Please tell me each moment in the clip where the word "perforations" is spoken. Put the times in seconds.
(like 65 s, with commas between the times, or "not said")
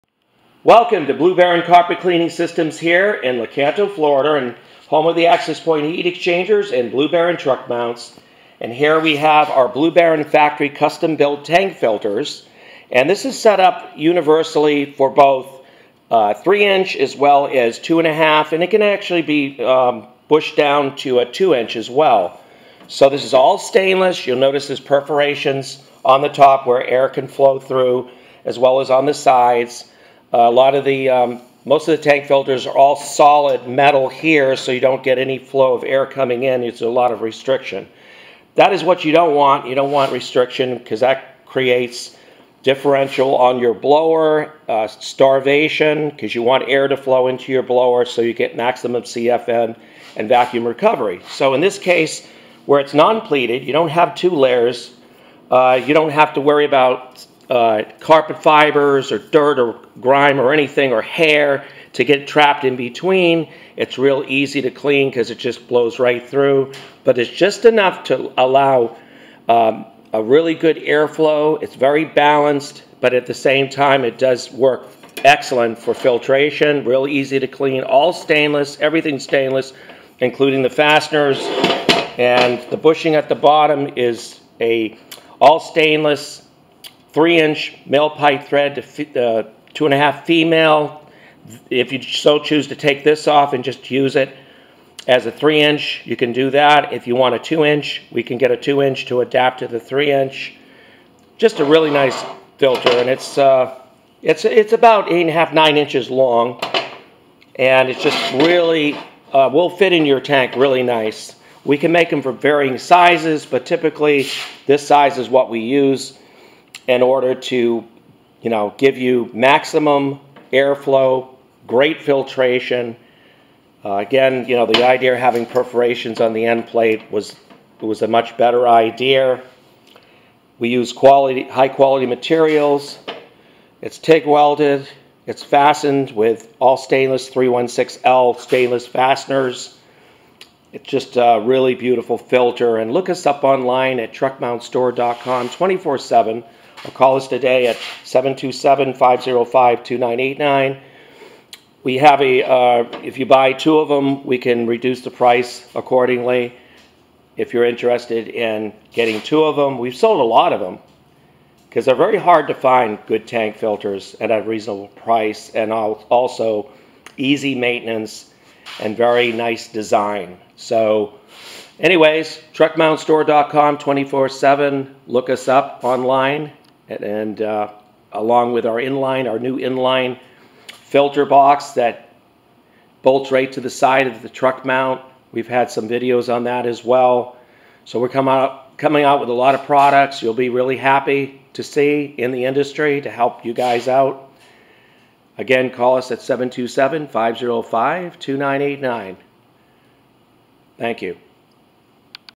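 24 s, 125 s.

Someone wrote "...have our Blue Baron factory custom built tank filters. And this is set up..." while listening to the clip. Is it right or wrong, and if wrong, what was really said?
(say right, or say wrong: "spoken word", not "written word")
right.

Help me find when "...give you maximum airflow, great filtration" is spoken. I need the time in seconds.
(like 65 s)
118 s.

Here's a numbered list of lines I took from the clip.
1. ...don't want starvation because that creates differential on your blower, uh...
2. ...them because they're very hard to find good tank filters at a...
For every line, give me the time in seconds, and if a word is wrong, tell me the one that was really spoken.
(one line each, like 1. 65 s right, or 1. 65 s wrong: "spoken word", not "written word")
1. 39 s wrong: "restriction", not "starvation"
2. 160 s right.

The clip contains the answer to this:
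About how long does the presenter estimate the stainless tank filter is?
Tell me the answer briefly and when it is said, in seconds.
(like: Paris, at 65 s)
8.5 to 9 inches, at 105 s.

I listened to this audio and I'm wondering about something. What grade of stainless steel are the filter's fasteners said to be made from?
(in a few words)
316L.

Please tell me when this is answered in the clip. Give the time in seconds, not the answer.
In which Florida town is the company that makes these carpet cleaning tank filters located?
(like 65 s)
3 s.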